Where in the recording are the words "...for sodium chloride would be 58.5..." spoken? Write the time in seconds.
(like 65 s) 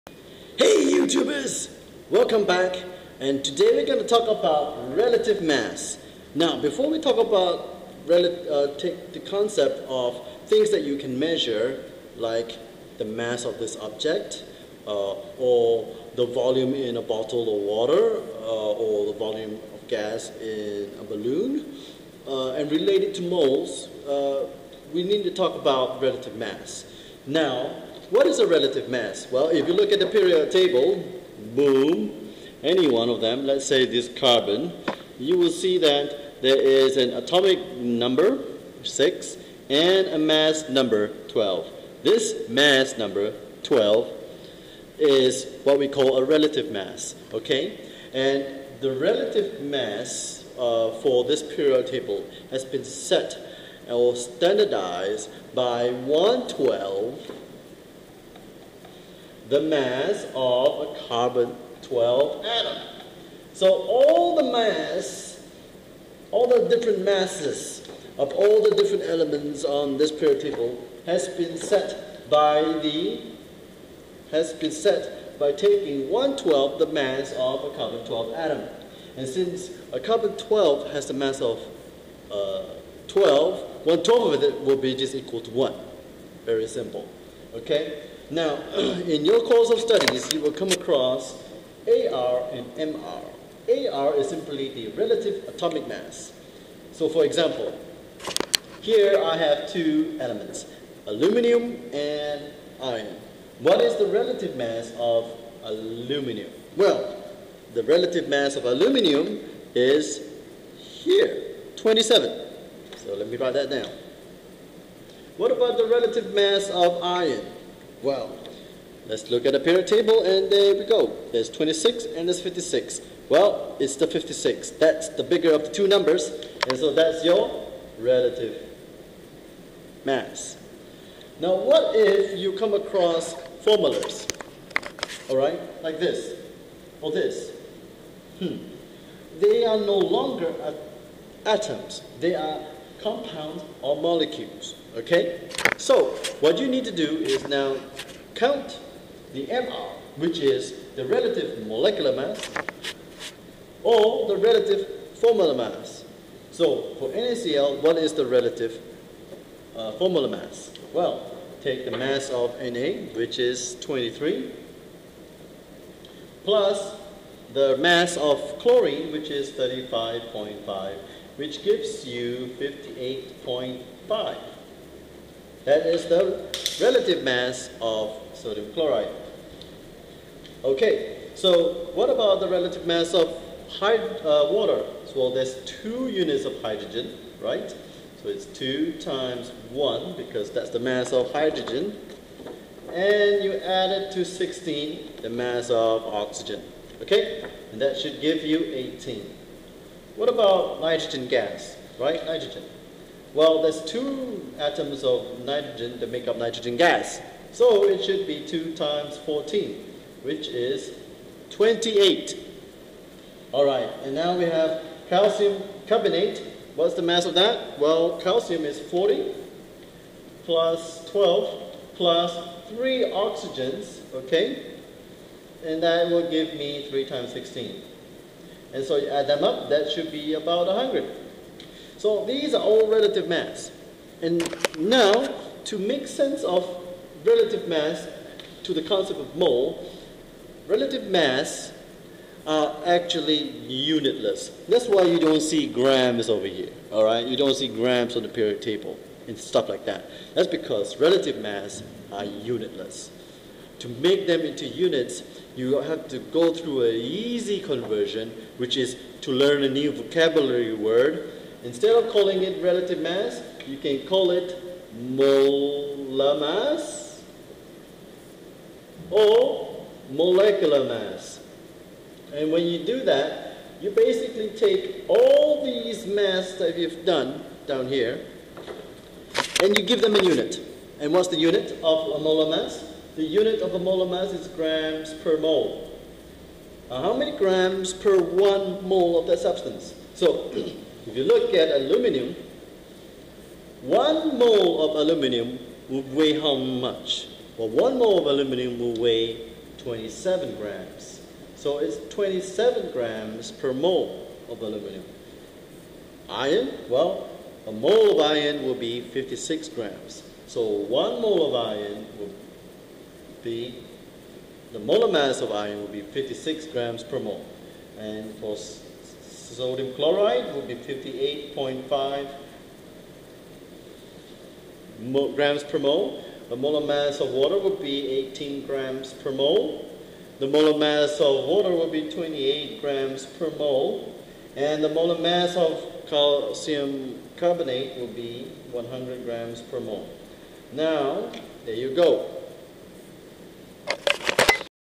318 s.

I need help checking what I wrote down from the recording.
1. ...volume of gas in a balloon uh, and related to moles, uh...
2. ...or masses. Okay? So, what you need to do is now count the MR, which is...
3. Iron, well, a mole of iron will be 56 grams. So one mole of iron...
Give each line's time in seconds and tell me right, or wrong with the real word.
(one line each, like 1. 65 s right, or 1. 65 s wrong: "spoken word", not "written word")
1. 19 s right
2. 143 s wrong: "molecules", not "masses"
3. 306 s right.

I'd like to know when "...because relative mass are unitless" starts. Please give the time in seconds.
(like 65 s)
250 s.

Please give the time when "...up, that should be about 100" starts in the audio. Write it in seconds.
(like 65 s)
229 s.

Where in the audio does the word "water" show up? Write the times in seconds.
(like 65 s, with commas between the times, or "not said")
17 s, 184 s, 327 s, 331 s.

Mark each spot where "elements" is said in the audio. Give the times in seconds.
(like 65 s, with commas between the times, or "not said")
69 s, 100 s.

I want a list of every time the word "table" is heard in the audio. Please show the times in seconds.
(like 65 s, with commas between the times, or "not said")
30 s, 51 s, 70 s, 119 s, 248 s.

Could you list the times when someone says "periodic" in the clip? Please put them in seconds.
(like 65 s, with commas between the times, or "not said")
30 s, 51 s, 70 s, 119 s, 248 s.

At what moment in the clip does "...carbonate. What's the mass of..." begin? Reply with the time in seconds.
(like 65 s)
215 s.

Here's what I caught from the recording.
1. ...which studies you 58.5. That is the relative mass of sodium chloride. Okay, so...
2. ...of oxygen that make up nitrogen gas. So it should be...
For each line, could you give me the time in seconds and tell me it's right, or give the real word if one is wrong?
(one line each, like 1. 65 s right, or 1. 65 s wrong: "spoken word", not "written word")
1. 171 s wrong: "gives", not "studies"
2. 205 s wrong: "nitrogen", not "oxygen".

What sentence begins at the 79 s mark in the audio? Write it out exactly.
And since a carbon 12 has the mass of uh, 12, 1 12 of it will be just equal to 1.